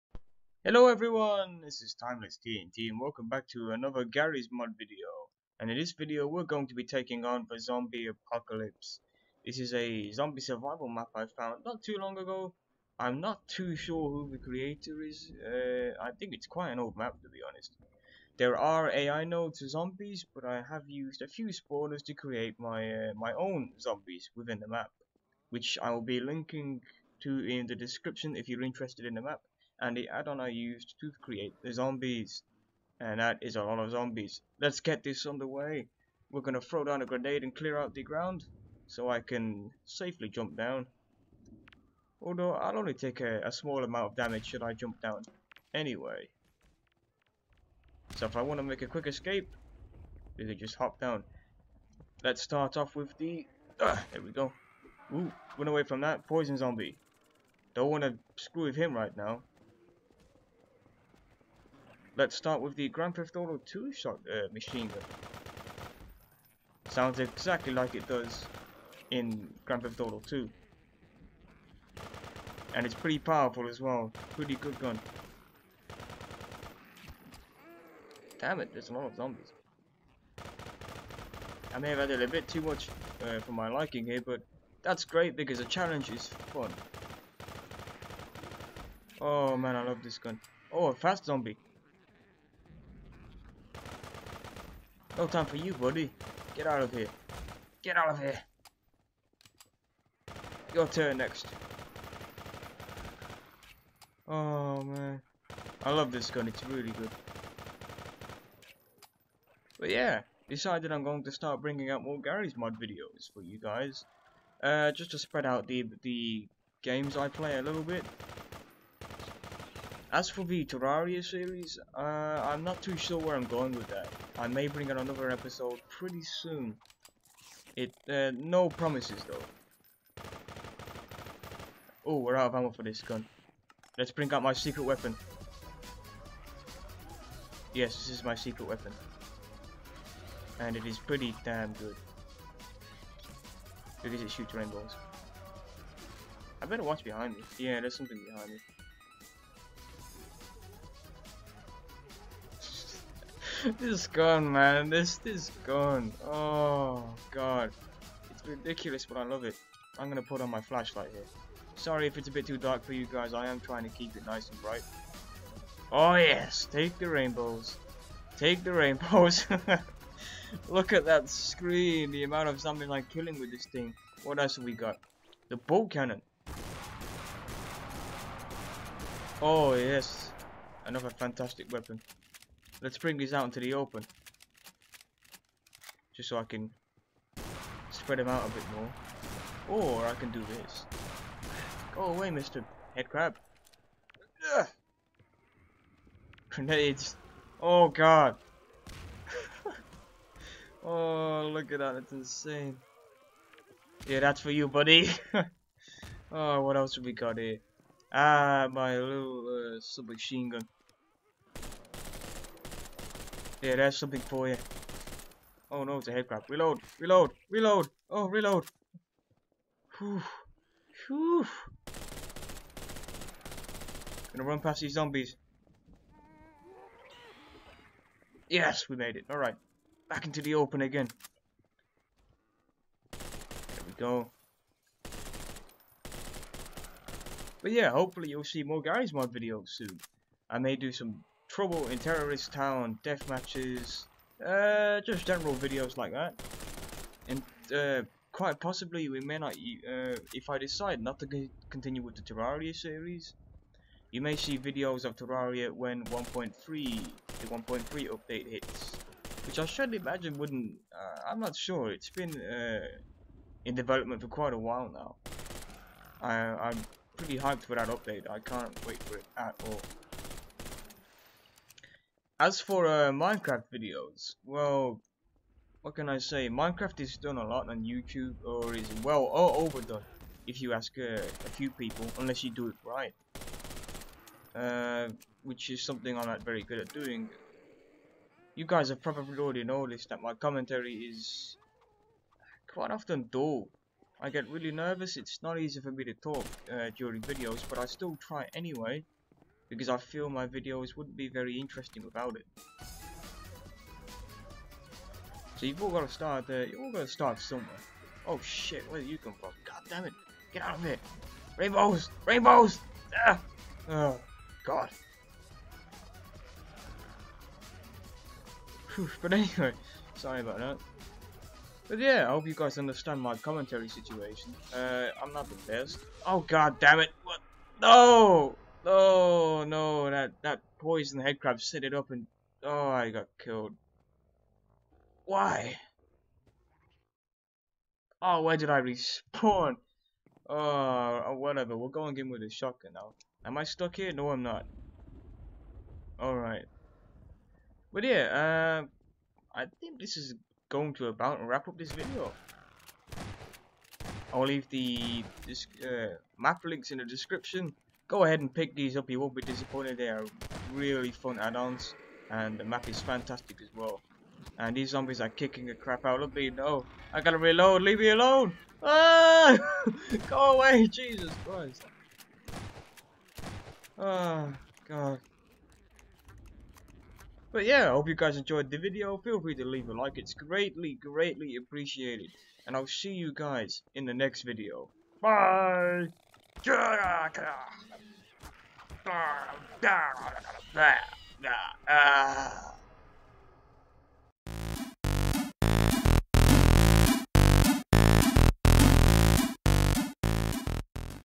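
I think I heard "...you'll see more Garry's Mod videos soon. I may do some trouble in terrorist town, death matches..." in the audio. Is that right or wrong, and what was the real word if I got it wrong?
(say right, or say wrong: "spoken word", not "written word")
right.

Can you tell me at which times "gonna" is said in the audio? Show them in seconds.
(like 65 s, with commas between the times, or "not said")
36 s, 224 s.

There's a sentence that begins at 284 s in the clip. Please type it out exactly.
Uh, which is something I'm not very good at doing.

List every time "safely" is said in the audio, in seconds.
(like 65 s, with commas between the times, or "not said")
39 s.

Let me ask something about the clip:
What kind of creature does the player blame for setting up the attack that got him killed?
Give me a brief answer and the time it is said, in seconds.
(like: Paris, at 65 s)
Poison headcrab, at 330 s.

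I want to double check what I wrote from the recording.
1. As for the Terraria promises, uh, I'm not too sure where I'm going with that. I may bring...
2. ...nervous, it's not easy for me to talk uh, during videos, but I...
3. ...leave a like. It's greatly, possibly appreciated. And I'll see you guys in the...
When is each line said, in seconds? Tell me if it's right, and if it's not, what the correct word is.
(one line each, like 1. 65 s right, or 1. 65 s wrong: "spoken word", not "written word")
1. 120 s wrong: "series", not "promises"
2. 294 s right
3. 379 s wrong: "greatly", not "possibly".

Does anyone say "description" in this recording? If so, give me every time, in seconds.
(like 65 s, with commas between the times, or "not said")
27 s, 357 s.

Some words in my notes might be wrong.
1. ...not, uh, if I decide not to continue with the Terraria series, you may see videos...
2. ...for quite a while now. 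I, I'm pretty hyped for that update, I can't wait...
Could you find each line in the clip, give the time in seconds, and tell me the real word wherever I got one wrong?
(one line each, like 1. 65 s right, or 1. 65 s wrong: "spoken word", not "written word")
1. 249 s right
2. 264 s right.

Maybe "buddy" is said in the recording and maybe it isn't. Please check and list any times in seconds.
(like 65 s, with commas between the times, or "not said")
95 s, 204 s.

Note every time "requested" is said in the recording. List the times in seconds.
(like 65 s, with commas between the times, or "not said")
not said.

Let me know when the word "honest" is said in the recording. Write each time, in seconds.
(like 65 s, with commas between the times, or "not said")
17 s.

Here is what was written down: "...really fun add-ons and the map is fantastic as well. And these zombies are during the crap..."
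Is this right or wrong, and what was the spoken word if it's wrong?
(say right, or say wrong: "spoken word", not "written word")
wrong: "kicking", not "during".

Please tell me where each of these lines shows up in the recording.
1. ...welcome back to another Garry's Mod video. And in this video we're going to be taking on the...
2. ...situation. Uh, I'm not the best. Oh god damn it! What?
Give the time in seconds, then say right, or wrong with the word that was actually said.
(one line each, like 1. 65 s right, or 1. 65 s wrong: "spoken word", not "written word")
1. 2 s right
2. 323 s right.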